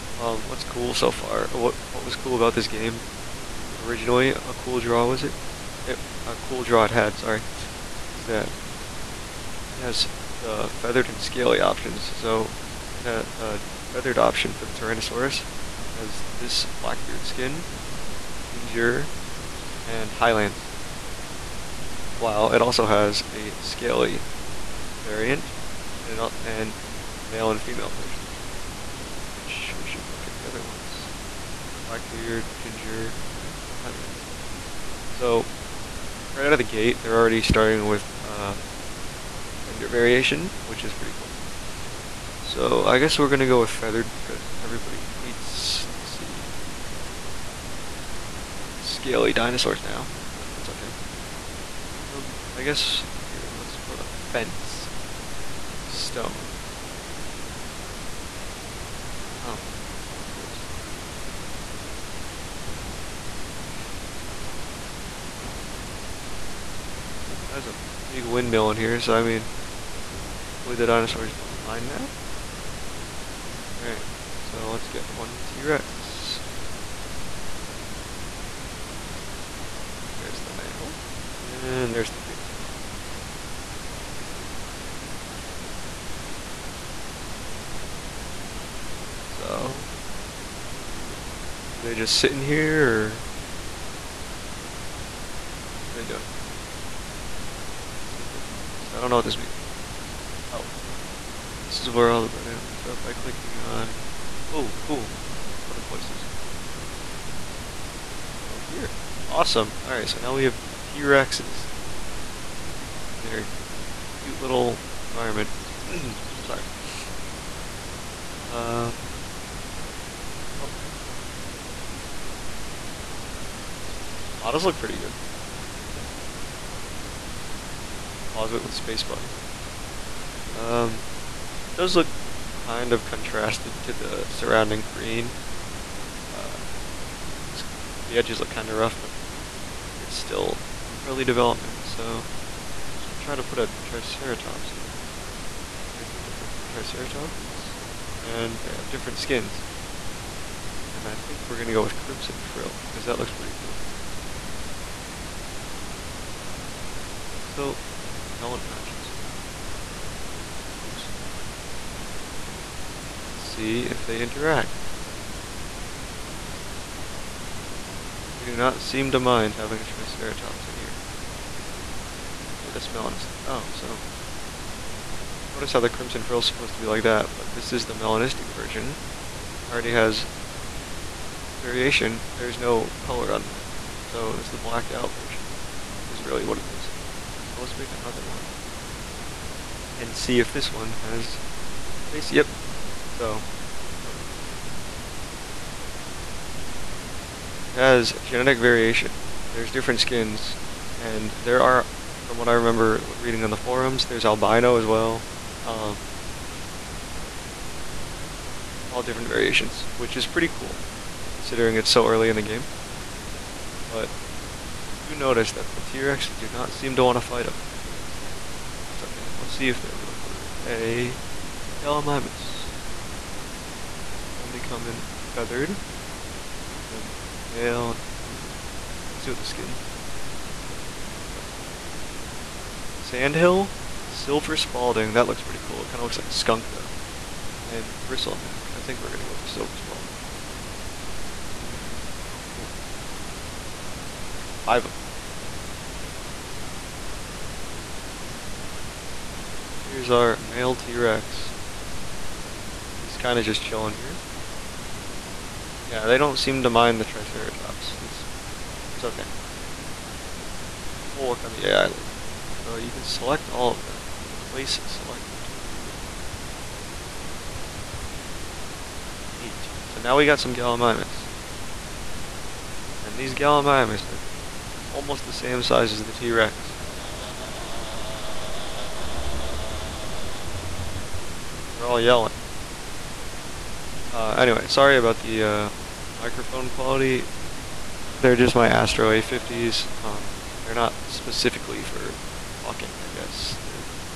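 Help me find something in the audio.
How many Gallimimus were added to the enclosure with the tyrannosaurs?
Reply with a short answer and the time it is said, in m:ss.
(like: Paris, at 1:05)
5, at 4:04.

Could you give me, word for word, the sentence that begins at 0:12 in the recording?
So it had the uh, feathered option for the Tyrannosaurus has this Blackbeard skin, Ginger, and Highlands.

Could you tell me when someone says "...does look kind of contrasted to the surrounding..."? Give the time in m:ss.
2:11.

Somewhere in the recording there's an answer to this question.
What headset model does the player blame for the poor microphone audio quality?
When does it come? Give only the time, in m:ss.
4:48.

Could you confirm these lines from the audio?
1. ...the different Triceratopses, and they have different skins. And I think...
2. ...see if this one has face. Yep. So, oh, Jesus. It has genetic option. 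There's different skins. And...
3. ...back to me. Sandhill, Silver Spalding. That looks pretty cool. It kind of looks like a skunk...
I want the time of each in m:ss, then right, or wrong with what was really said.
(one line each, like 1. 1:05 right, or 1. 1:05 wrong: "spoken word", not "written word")
1. 2:26 right
2. 3:10 wrong: "variation", not "option"
3. 3:51 right.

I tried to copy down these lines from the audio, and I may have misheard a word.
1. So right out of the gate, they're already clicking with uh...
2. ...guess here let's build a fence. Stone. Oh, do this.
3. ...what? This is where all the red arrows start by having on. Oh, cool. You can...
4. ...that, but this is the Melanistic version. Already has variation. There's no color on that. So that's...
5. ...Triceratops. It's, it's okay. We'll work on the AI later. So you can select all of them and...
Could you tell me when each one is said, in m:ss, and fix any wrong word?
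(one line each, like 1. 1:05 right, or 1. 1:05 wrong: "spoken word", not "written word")
1. 0:35 wrong: "starting", not "clicking"
2. 0:52 right
3. 1:40 wrong: "clicking", not "having"
4. 2:57 right
5. 4:17 right.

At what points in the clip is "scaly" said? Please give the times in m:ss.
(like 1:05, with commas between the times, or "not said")
0:11, 0:23, 0:48.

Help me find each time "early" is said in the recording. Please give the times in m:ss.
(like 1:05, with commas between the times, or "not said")
2:21, 3:32.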